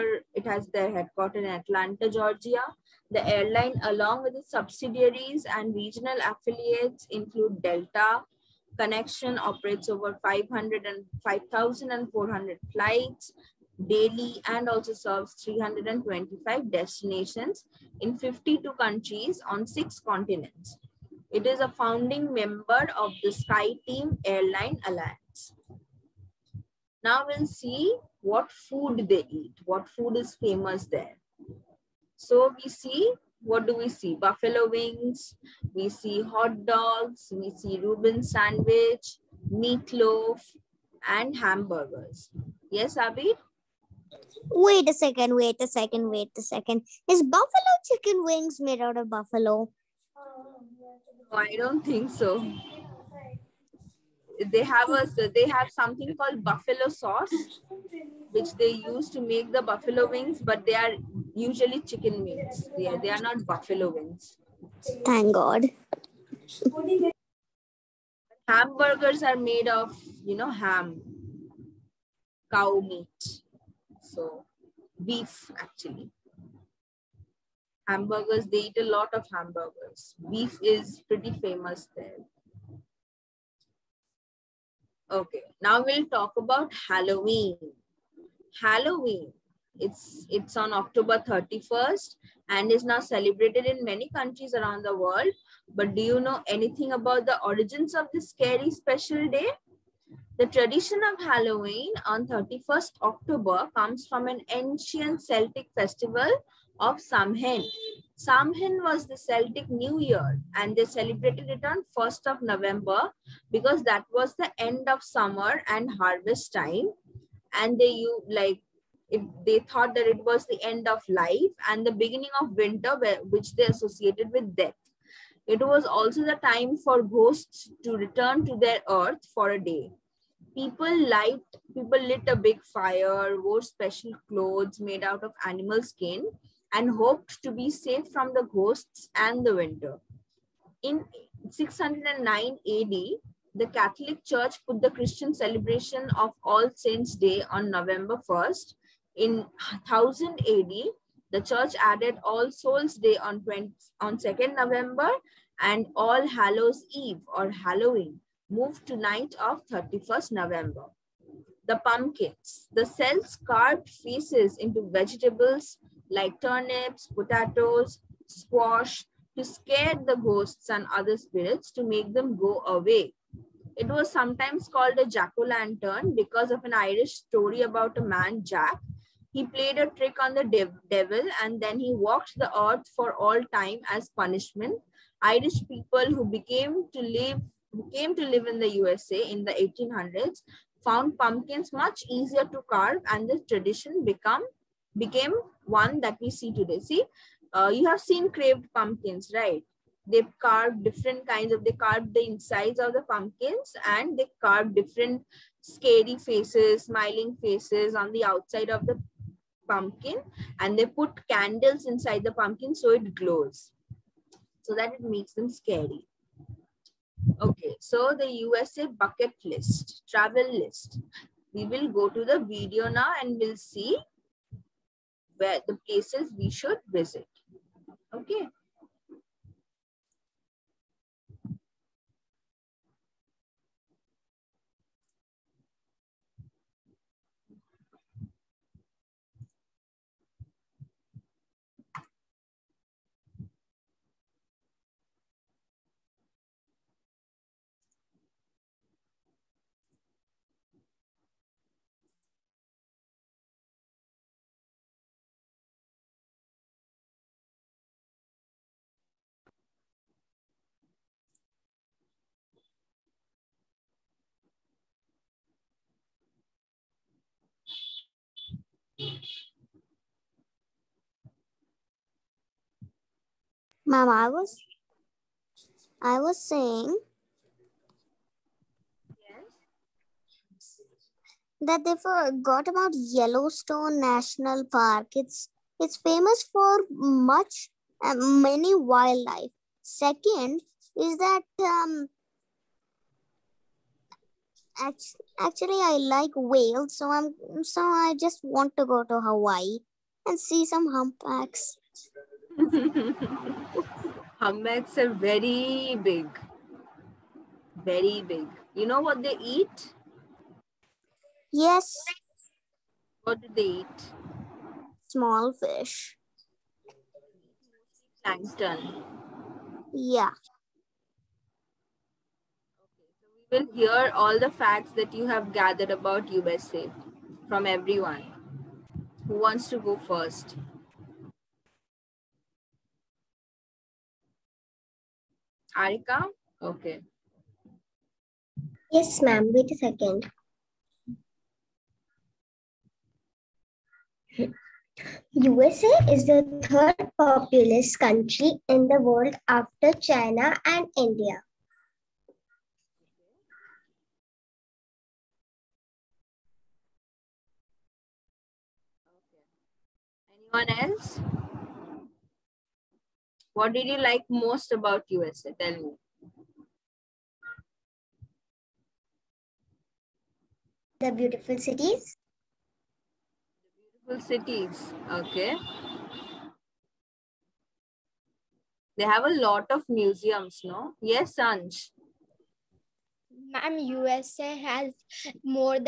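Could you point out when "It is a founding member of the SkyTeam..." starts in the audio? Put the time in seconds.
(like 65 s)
21 s.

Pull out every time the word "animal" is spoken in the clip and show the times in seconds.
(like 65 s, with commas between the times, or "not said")
135 s.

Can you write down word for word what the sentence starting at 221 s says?
We will go to the video now and we'll see where the places we should visit.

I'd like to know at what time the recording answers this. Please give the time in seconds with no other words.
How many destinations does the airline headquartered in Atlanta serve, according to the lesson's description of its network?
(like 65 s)
15 s.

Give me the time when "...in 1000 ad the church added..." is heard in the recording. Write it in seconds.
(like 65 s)
149 s.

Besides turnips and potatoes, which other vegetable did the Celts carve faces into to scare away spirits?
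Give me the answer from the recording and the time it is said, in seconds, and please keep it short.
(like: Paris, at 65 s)
Squash, at 168 s.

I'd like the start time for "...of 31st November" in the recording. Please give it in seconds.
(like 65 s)
159 s.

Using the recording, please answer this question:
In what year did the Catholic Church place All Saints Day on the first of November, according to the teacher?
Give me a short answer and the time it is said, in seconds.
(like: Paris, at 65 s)
609 AD, at 141 s.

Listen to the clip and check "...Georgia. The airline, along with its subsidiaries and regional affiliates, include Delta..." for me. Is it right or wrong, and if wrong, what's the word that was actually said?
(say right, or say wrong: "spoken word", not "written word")
right.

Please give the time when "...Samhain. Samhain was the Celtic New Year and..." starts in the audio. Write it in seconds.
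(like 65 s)
106 s.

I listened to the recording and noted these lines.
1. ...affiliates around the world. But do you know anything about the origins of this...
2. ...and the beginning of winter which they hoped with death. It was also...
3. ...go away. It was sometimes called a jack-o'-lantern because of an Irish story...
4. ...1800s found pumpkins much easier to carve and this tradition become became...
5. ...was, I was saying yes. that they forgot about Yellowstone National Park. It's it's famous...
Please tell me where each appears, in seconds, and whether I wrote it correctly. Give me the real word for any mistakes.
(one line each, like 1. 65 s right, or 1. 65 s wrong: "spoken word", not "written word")
1. 94 s wrong: "countries", not "affiliates"
2. 121 s wrong: "associated", not "hoped"
3. 172 s right
4. 189 s right
5. 274 s right.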